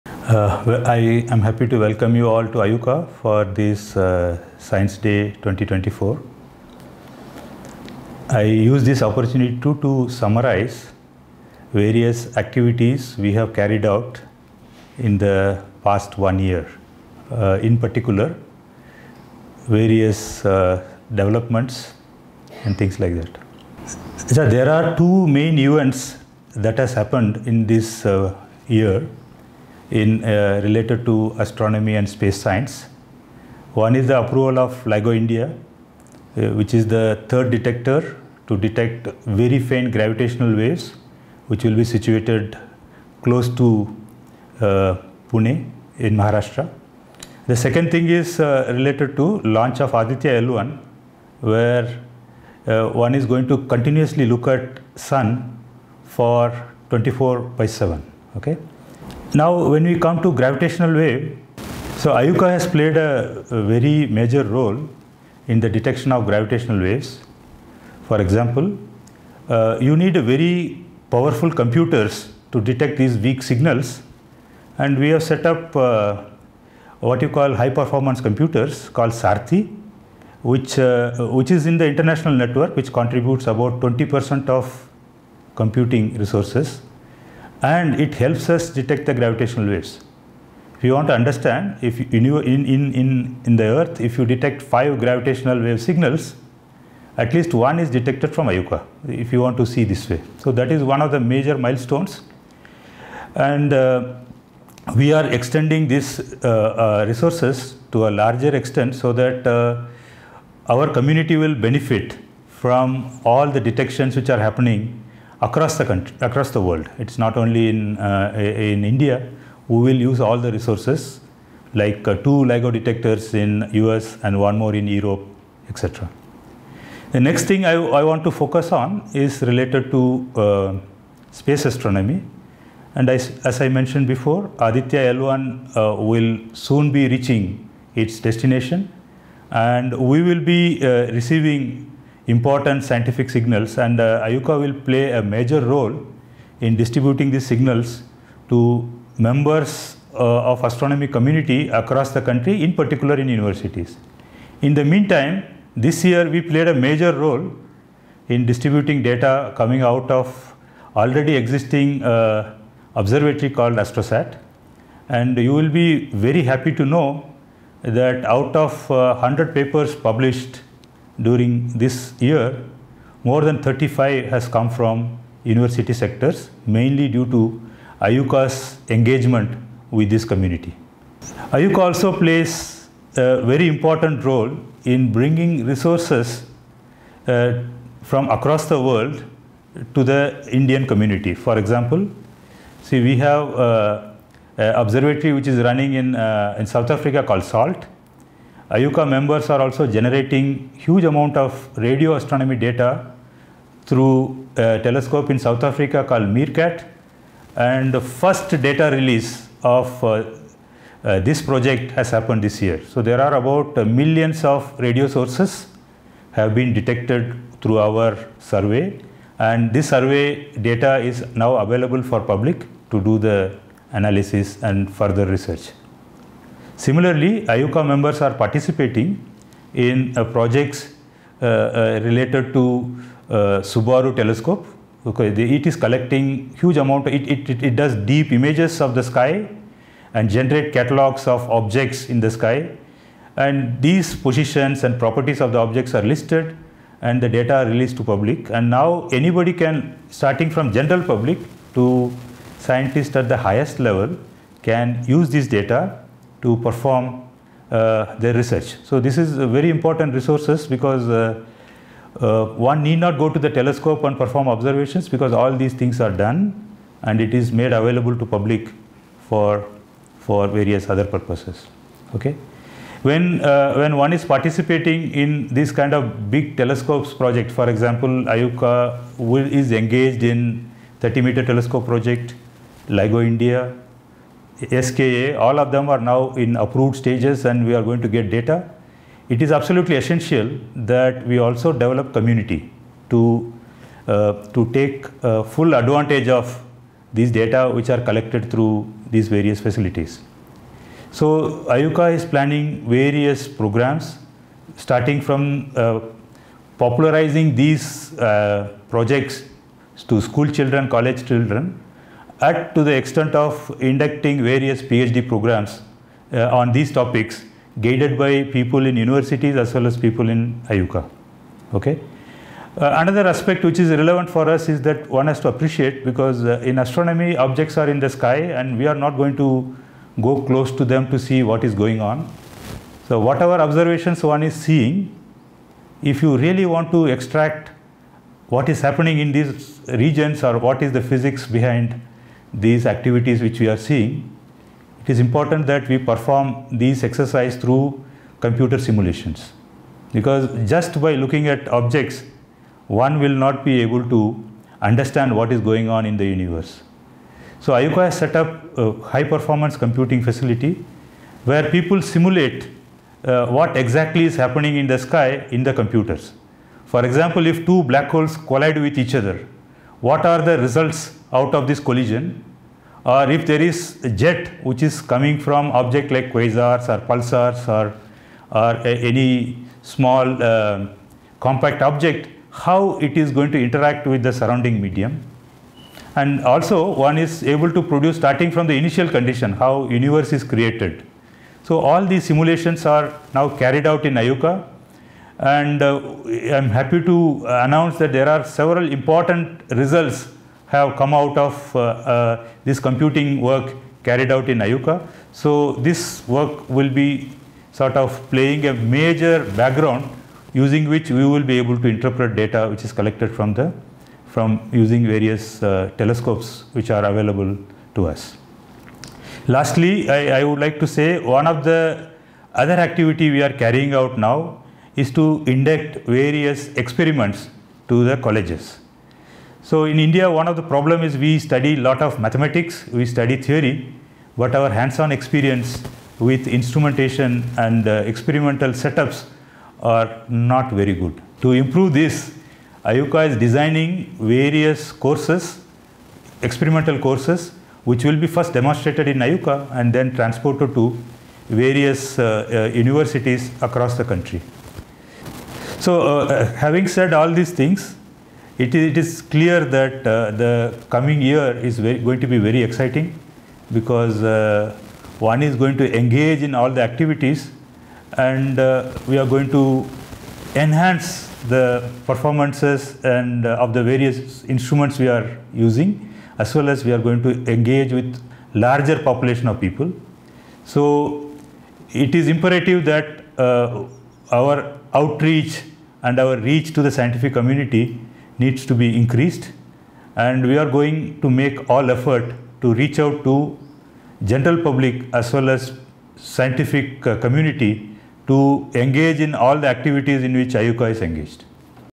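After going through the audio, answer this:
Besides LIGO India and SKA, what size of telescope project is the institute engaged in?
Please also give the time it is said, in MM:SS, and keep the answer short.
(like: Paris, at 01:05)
30 meter, at 04:40.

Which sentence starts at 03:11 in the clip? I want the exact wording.
For example, see we have uh, an observatory which is running in, uh, in South Africa called SALT.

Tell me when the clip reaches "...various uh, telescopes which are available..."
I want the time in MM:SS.
06:55.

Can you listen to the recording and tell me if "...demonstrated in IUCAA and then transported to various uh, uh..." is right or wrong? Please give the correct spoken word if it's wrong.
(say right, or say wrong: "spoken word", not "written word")
right.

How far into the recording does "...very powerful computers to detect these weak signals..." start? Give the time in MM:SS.
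01:10.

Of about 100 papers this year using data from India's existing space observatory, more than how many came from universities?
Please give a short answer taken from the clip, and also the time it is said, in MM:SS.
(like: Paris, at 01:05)
35, at 02:53.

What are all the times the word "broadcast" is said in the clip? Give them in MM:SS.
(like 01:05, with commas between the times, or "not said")
not said.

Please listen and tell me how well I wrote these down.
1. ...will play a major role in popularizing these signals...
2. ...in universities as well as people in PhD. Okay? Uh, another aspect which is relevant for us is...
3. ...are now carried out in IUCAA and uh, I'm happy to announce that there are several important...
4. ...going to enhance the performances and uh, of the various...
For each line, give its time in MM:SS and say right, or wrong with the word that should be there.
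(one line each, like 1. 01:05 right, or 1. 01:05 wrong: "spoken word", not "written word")
1. 02:24 wrong: "distributing", not "popularizing"
2. 05:18 wrong: "IUCAA", not "PhD"
3. 06:32 right
4. 07:49 right.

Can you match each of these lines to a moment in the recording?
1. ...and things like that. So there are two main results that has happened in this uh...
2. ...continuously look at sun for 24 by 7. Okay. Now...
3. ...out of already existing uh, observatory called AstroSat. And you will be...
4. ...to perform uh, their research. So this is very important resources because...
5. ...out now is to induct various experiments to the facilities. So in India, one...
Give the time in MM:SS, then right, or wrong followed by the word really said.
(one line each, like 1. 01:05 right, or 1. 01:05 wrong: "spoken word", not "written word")
1. 00:22 wrong: "events", not "results"
2. 00:53 right
3. 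02:39 right
4. 04:16 right
5. 07:03 wrong: "colleges", not "facilities".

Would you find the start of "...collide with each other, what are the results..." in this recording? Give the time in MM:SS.
06:08.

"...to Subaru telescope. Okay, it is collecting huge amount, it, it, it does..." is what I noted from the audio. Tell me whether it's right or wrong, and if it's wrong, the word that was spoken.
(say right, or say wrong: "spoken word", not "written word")
right.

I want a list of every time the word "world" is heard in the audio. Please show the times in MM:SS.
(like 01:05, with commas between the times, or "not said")
01:56, 03:08.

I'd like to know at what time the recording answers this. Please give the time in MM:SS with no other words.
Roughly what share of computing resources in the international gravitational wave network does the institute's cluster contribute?
01:23.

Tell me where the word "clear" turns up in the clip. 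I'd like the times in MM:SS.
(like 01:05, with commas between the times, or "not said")
07:39.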